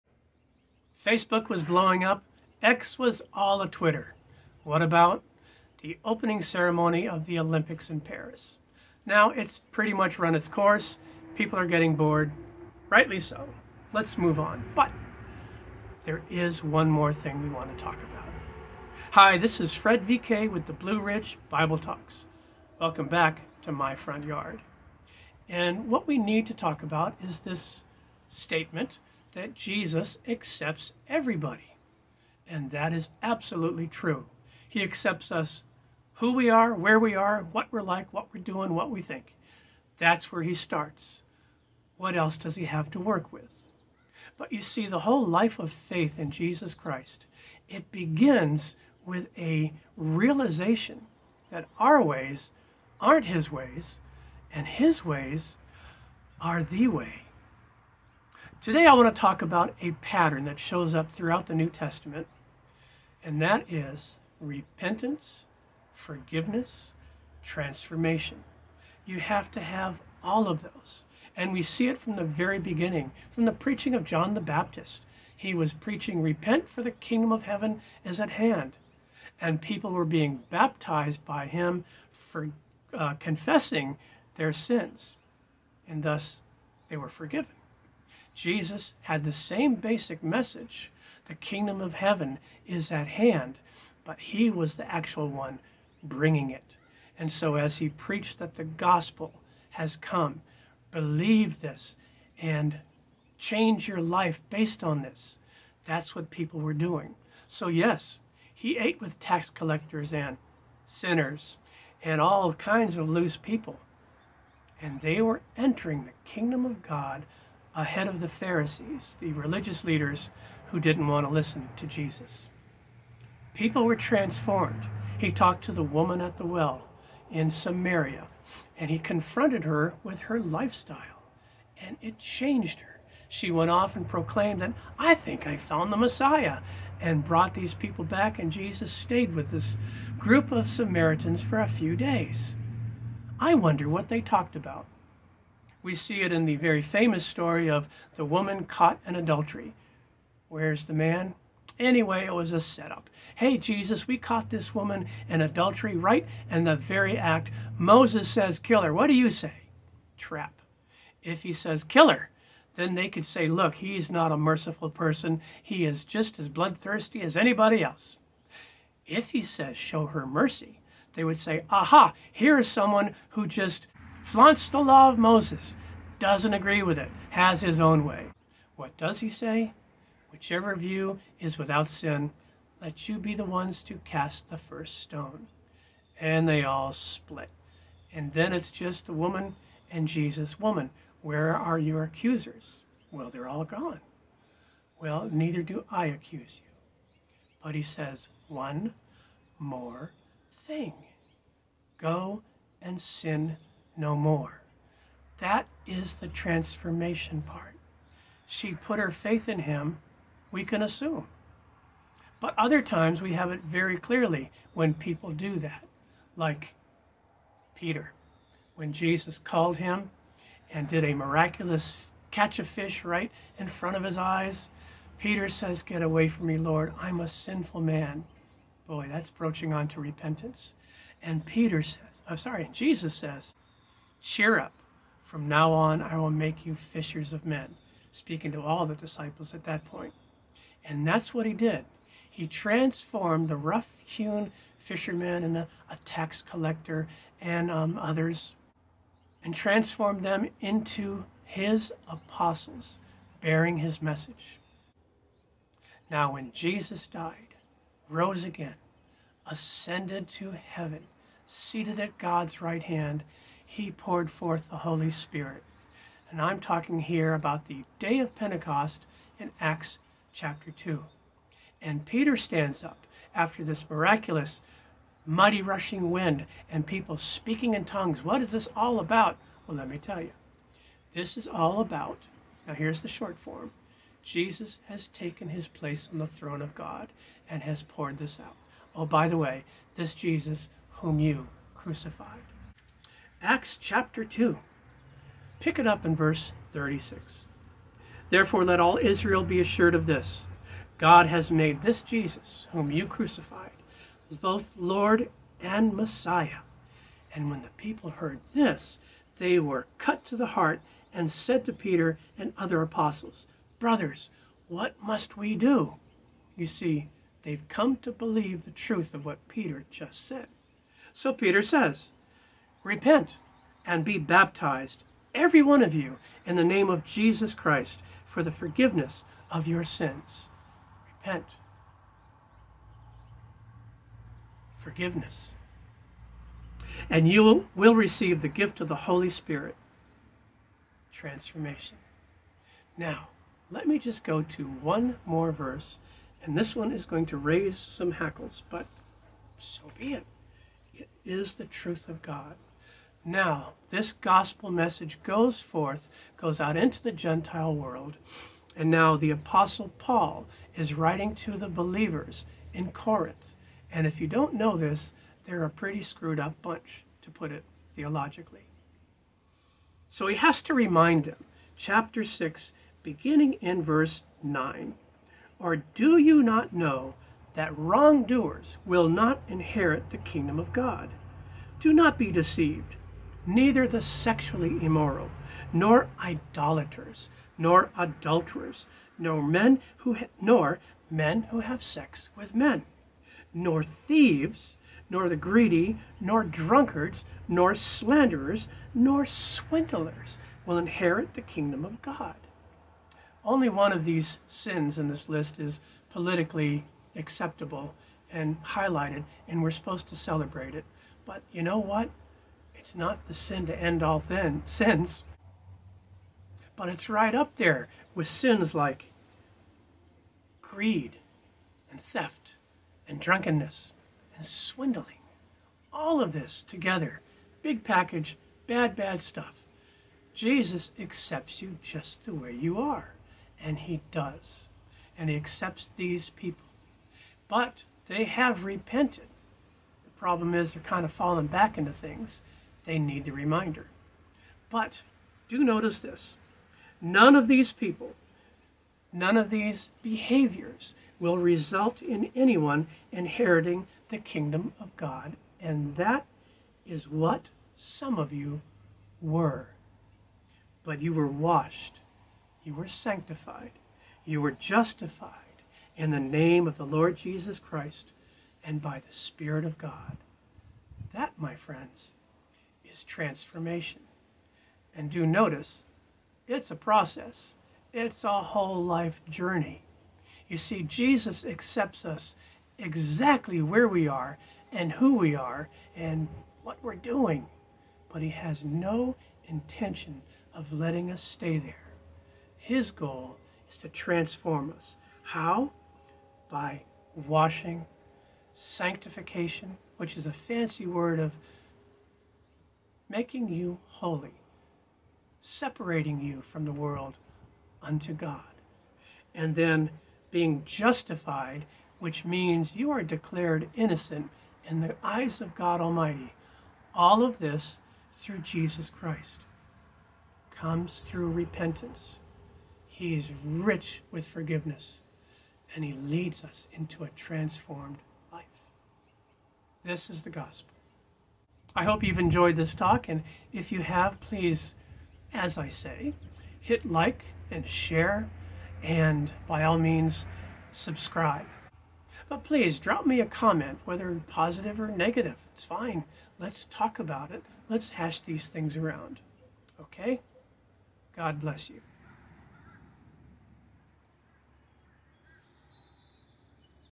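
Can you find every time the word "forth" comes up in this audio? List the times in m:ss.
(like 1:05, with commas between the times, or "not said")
4:24, 5:55.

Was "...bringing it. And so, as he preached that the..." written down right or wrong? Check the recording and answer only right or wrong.
right.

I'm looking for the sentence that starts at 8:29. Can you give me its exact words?
And then being justified, which means you are declared innocent in the eyes of God Almighty.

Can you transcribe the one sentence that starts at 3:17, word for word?
But he says, One more thing go and sin no more.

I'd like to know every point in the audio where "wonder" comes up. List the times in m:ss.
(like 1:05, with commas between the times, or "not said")
2:23.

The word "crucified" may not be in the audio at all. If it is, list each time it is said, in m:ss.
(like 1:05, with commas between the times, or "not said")
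4:51, 5:03.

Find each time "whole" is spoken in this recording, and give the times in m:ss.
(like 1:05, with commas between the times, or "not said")
0:44, 7:58.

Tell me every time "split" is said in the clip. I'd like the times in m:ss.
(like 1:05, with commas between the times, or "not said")
3:06.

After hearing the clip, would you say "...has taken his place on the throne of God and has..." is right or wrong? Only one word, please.
right.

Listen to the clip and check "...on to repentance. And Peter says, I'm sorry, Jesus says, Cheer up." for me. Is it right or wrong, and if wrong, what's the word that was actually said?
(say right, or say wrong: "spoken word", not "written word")
right.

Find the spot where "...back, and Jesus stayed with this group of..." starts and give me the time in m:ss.
2:18.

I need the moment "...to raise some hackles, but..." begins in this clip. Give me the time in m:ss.
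5:47.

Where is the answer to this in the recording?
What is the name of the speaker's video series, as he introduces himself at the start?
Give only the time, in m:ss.
0:20.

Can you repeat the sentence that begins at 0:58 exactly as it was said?
Today I want to talk about a pattern that shows up throughout the New Testament, and that is repentance, forgiveness, transformation.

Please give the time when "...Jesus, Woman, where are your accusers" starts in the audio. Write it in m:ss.
3:10.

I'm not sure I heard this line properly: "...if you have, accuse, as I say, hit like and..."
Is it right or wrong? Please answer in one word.
wrong.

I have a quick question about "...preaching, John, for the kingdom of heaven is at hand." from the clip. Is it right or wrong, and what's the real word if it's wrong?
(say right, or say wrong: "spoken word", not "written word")
wrong: "Repent", not "John".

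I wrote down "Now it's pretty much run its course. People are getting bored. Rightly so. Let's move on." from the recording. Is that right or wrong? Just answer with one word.
right.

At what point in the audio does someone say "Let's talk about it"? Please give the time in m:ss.
9:06.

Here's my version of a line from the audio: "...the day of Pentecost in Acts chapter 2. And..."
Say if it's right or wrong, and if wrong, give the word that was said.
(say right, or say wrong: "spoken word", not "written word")
right.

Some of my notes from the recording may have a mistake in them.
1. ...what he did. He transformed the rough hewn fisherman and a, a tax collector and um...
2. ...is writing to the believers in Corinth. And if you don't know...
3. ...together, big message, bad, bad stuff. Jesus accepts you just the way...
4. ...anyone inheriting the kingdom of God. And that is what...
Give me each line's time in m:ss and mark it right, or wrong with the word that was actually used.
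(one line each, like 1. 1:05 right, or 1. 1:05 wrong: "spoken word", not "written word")
1. 4:01 right
2. 6:00 right
3. 7:06 wrong: "package", not "message"
4. 7:32 right.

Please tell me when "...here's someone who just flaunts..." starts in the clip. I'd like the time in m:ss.
2:52.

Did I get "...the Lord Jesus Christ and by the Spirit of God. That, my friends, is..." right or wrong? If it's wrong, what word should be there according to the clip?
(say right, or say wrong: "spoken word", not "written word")
right.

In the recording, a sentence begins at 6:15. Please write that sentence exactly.
Or do you not know that wrongdoers will not inherit the kingdom of God?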